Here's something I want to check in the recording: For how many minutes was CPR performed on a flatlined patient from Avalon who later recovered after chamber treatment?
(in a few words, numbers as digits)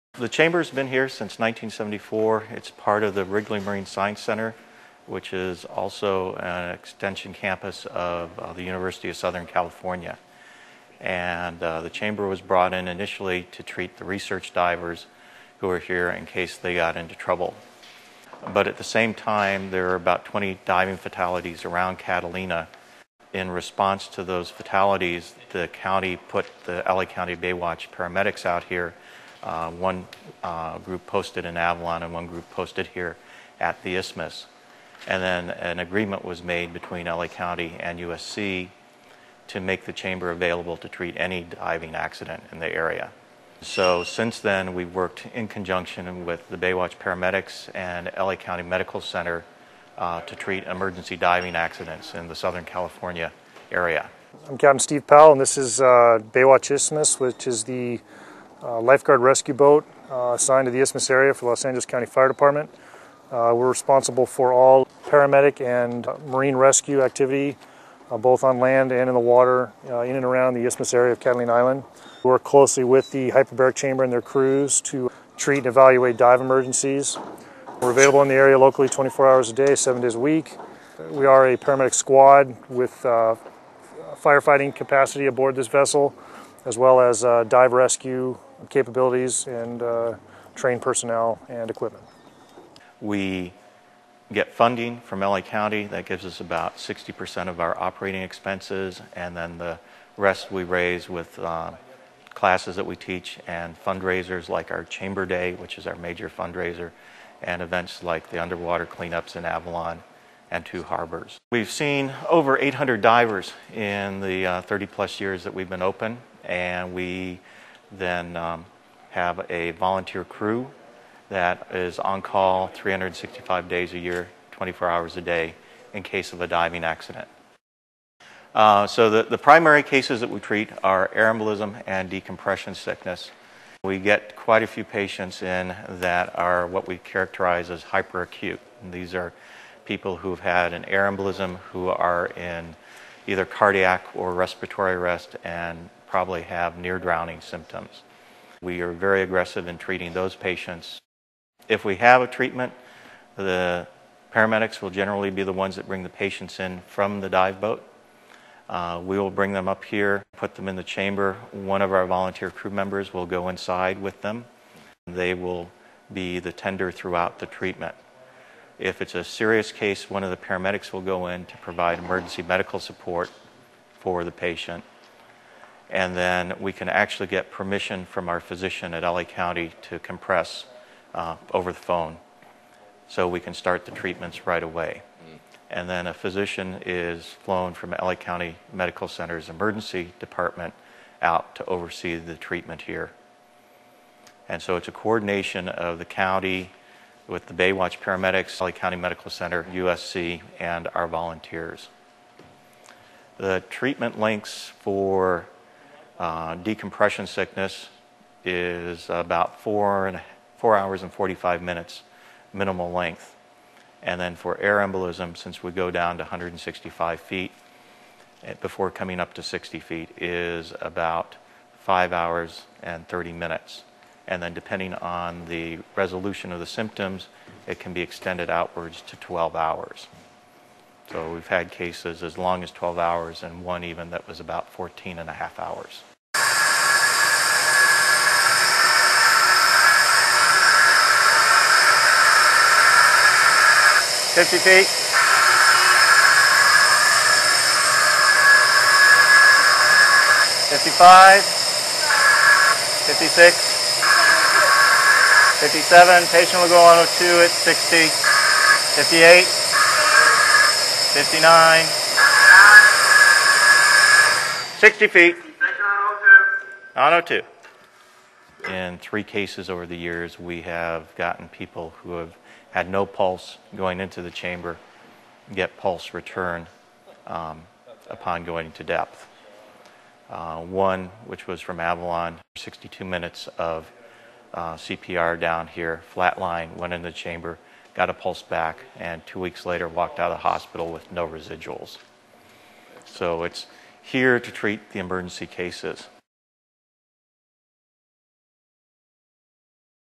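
62.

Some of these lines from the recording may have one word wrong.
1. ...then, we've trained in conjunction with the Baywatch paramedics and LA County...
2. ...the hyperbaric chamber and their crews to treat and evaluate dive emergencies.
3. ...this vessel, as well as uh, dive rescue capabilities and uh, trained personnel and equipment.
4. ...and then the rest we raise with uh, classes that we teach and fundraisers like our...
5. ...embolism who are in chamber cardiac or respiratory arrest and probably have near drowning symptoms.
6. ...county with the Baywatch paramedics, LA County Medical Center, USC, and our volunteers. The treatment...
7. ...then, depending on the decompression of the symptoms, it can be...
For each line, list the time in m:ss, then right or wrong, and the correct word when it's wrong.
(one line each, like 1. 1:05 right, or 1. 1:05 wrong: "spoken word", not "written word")
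1. 0:44 wrong: "worked", not "trained"
2. 1:13 right
3. 1:25 right
4. 1:39 right
5. 2:21 wrong: "either", not "chamber"
6. 3:16 right
7. 3:44 wrong: "resolution", not "decompression".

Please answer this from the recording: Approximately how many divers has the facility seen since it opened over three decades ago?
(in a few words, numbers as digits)
800.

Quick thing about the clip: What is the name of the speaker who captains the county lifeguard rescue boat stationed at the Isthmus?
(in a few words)
Steve Powell.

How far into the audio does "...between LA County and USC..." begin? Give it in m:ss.
0:36.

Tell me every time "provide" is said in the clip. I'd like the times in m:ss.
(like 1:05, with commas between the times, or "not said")
2:51.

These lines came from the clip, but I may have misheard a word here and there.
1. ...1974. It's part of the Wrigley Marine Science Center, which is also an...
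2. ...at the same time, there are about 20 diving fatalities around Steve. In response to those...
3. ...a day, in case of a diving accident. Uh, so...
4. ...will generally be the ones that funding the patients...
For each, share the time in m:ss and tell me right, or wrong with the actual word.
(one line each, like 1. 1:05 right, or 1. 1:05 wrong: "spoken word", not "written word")
1. 0:01 right
2. 0:18 wrong: "Catalina", not "Steve"
3. 2:05 right
4. 2:34 wrong: "bring", not "funding".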